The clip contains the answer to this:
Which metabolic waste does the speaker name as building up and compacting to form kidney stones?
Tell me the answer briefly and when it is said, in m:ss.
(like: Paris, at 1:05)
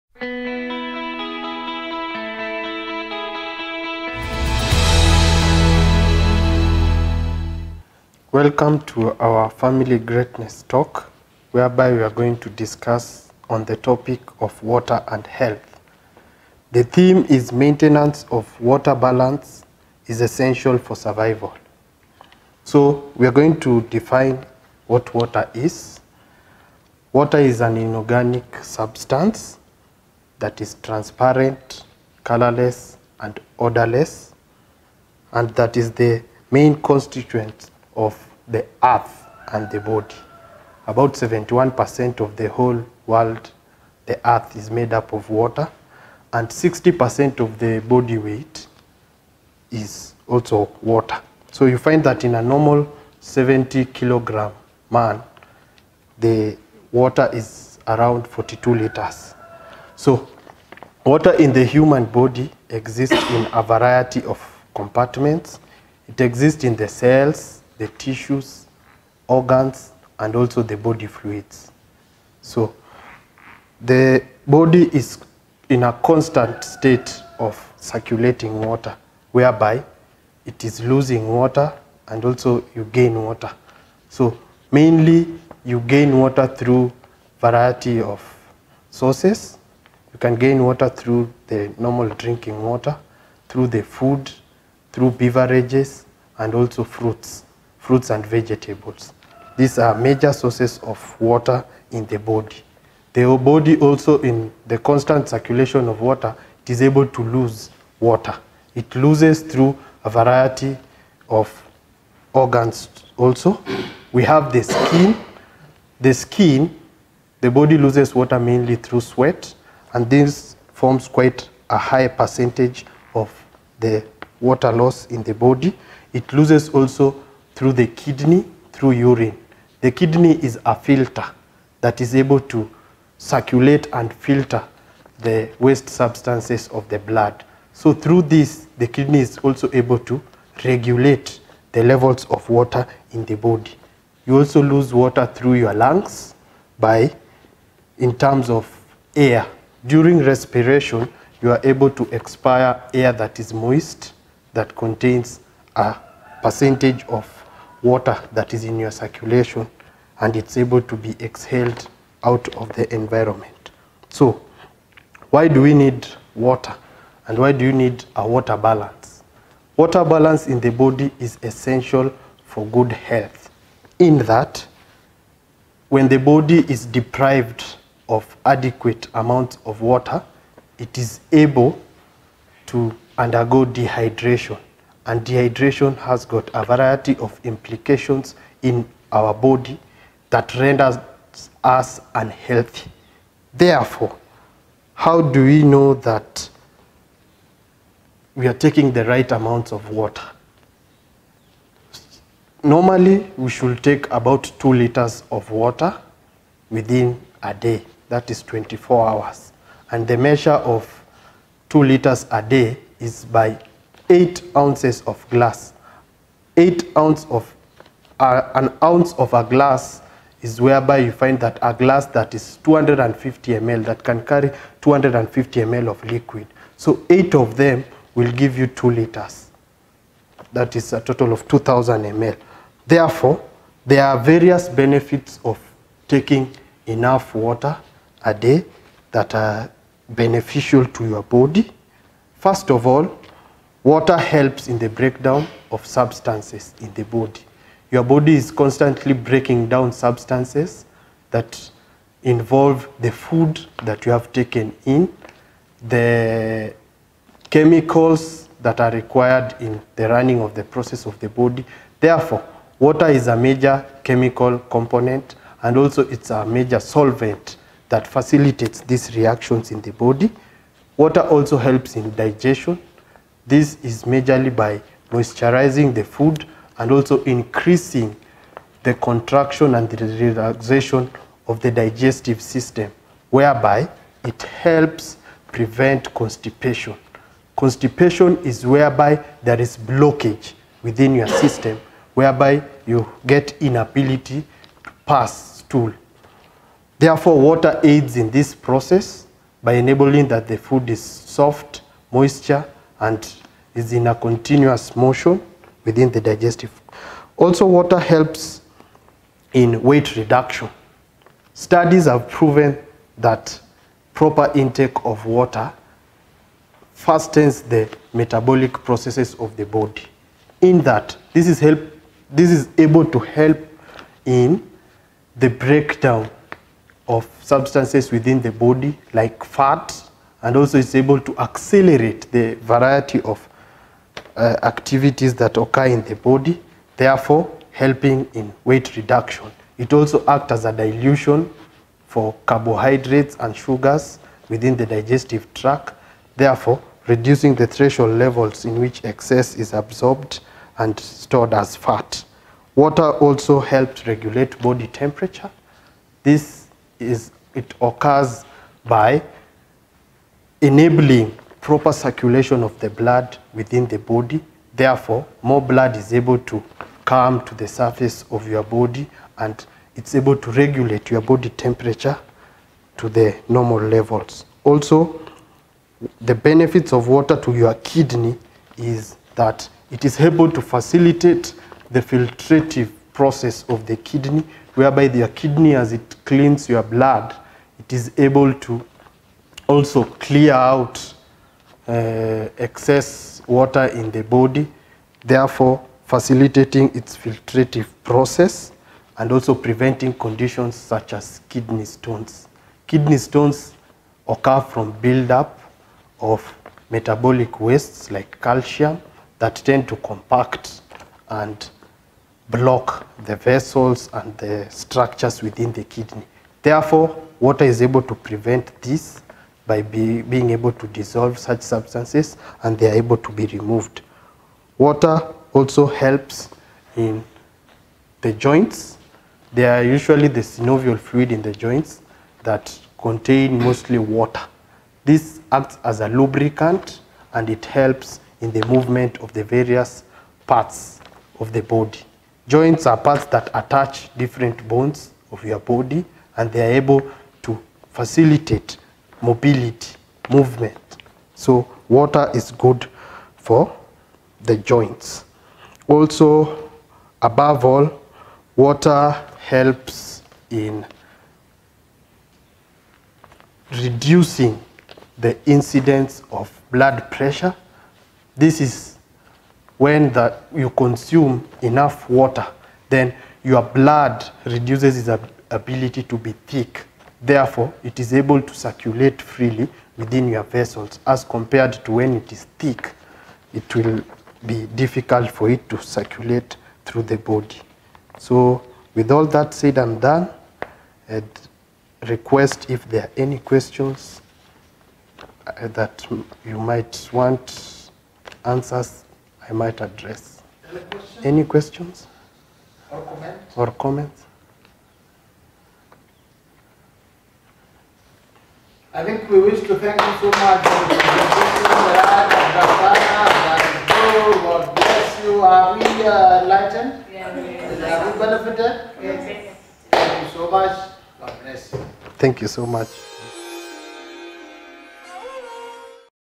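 calcium, at 6:48.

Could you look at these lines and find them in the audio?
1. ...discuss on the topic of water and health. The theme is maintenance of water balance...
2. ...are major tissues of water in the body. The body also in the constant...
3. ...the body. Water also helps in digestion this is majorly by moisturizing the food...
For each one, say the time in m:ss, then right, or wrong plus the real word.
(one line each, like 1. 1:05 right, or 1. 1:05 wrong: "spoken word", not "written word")
1. 0:12 right
2. 1:39 wrong: "sources", not "tissues"
3. 4:29 right.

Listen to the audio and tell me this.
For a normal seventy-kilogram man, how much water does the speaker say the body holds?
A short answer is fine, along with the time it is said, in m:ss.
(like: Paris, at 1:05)
42 liters, at 0:58.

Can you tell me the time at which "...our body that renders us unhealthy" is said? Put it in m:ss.
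3:09.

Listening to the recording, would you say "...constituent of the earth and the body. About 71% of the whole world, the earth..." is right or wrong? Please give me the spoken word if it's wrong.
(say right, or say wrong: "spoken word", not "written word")
right.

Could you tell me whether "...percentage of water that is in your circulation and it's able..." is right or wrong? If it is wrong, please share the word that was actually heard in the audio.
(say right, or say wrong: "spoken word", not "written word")
right.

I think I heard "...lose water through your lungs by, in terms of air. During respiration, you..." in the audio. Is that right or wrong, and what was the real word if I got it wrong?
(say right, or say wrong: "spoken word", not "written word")
right.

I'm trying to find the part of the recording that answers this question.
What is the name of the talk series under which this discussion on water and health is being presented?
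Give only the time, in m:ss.
0:09.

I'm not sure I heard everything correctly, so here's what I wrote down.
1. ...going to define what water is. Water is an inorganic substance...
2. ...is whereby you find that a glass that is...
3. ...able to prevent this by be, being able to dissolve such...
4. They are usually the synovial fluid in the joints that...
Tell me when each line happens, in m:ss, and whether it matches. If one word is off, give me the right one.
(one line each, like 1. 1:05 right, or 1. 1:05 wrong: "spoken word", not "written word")
1. 0:23 right
2. 3:40 right
3. 6:57 right
4. 7:09 right.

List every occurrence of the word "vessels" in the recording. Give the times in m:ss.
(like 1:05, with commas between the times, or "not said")
6:53, 8:00.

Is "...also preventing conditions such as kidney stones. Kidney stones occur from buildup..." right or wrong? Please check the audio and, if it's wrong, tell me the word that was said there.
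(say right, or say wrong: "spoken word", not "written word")
right.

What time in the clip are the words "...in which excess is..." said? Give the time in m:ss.
5:48.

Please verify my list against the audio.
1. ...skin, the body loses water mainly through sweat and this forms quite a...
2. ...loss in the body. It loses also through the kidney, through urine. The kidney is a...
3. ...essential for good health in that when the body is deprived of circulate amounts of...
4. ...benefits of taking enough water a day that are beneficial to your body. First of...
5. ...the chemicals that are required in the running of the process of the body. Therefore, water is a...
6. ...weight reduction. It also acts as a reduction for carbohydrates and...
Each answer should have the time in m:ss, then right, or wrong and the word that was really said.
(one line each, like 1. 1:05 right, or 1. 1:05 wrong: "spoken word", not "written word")
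1. 1:56 right
2. 2:04 right
3. 2:51 wrong: "adequate", not "circulate"
4. 3:54 right
5. 4:15 right
6. 5:38 wrong: "dilution", not "reduction".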